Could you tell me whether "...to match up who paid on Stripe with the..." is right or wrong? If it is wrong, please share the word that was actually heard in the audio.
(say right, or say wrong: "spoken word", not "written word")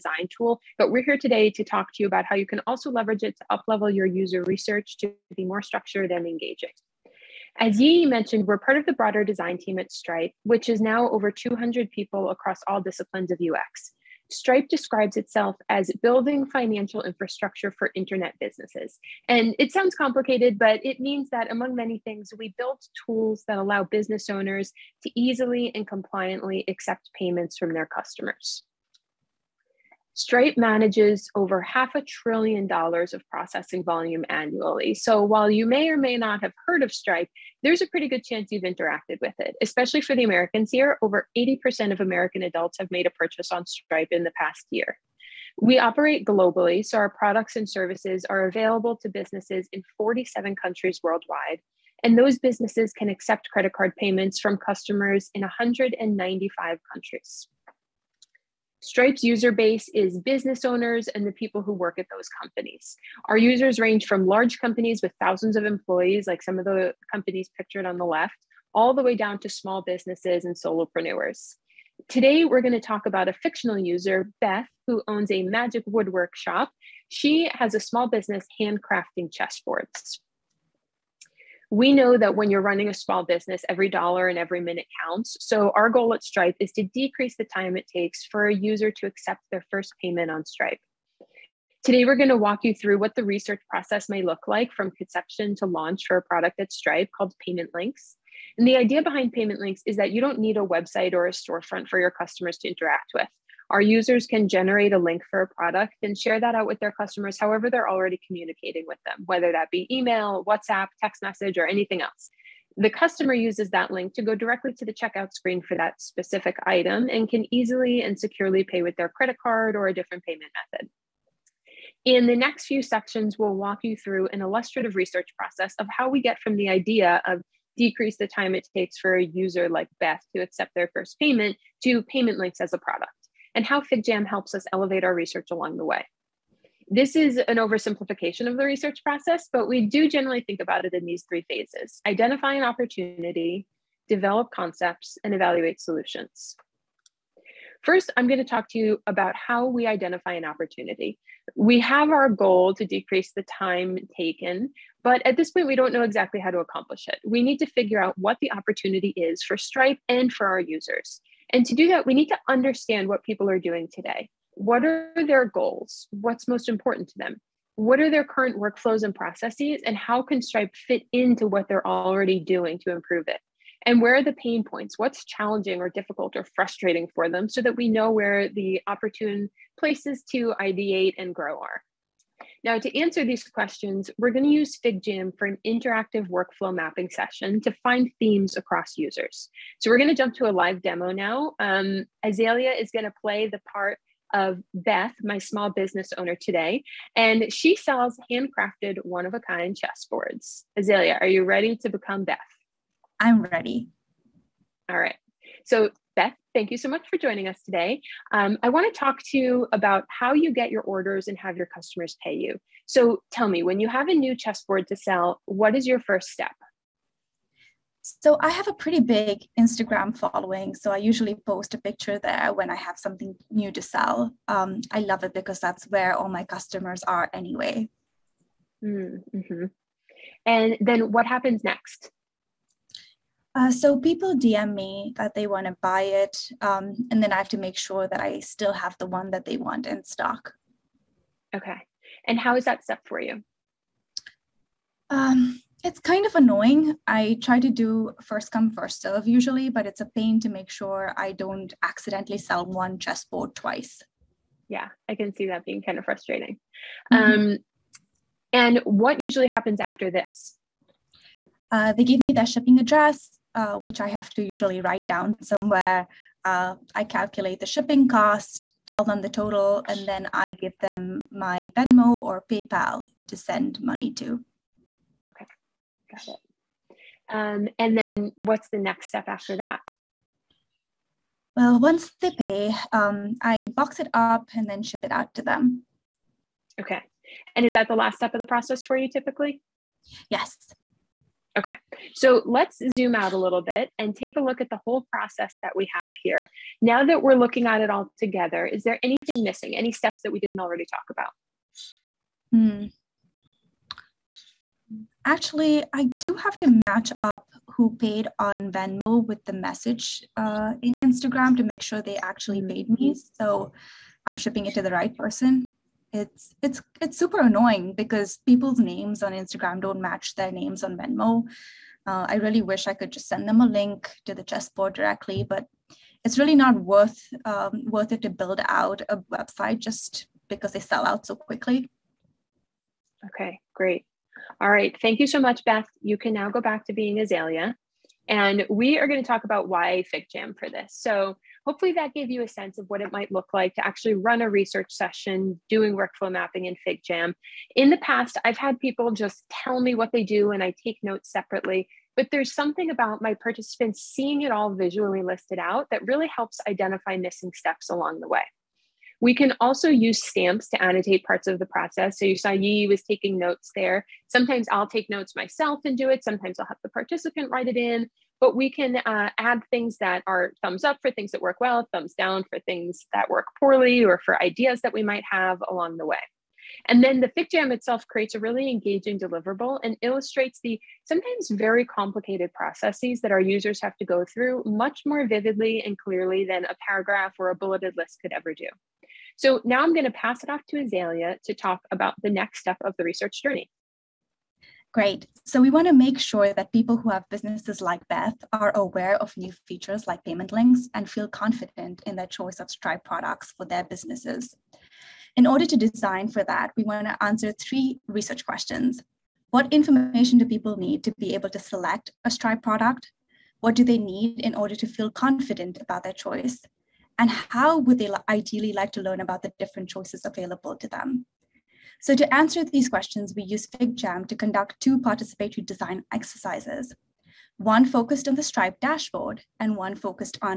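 wrong: "Venmo", not "Stripe".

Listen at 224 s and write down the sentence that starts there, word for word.
Um, I love it because that's where all my customers are anyway.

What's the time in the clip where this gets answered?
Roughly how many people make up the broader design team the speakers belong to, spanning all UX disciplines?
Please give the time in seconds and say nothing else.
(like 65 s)
11 s.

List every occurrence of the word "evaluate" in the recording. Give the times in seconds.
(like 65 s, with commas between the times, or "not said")
145 s.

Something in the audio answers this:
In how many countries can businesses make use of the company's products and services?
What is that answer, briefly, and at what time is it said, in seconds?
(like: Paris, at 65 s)
47, at 49 s.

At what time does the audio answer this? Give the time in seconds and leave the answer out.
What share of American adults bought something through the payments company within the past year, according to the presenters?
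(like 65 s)
41 s.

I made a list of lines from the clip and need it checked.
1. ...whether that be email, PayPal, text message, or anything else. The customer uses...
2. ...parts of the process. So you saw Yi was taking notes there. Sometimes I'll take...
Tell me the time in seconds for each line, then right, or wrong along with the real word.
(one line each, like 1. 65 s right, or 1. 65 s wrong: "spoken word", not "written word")
1. 109 s wrong: "WhatsApp", not "PayPal"
2. 361 s right.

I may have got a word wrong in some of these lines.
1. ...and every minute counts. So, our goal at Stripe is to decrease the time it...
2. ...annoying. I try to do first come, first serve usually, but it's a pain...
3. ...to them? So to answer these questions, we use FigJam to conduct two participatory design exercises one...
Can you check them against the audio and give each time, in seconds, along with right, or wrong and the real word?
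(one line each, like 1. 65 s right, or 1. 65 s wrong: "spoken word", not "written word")
1. 84 s right
2. 246 s right
3. 420 s right.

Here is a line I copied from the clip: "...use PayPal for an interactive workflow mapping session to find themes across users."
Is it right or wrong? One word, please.
wrong.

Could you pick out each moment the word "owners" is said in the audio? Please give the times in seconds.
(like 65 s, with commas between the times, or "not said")
24 s, 60 s, 196 s.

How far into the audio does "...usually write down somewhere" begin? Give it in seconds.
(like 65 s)
264 s.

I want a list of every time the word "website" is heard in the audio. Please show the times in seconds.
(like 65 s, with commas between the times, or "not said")
100 s, 329 s.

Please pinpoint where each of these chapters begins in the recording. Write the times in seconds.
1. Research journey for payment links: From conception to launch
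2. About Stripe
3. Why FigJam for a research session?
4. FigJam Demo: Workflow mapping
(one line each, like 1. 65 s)
1. 81 s
2. 6 s
3. 341 s
4. 182 s.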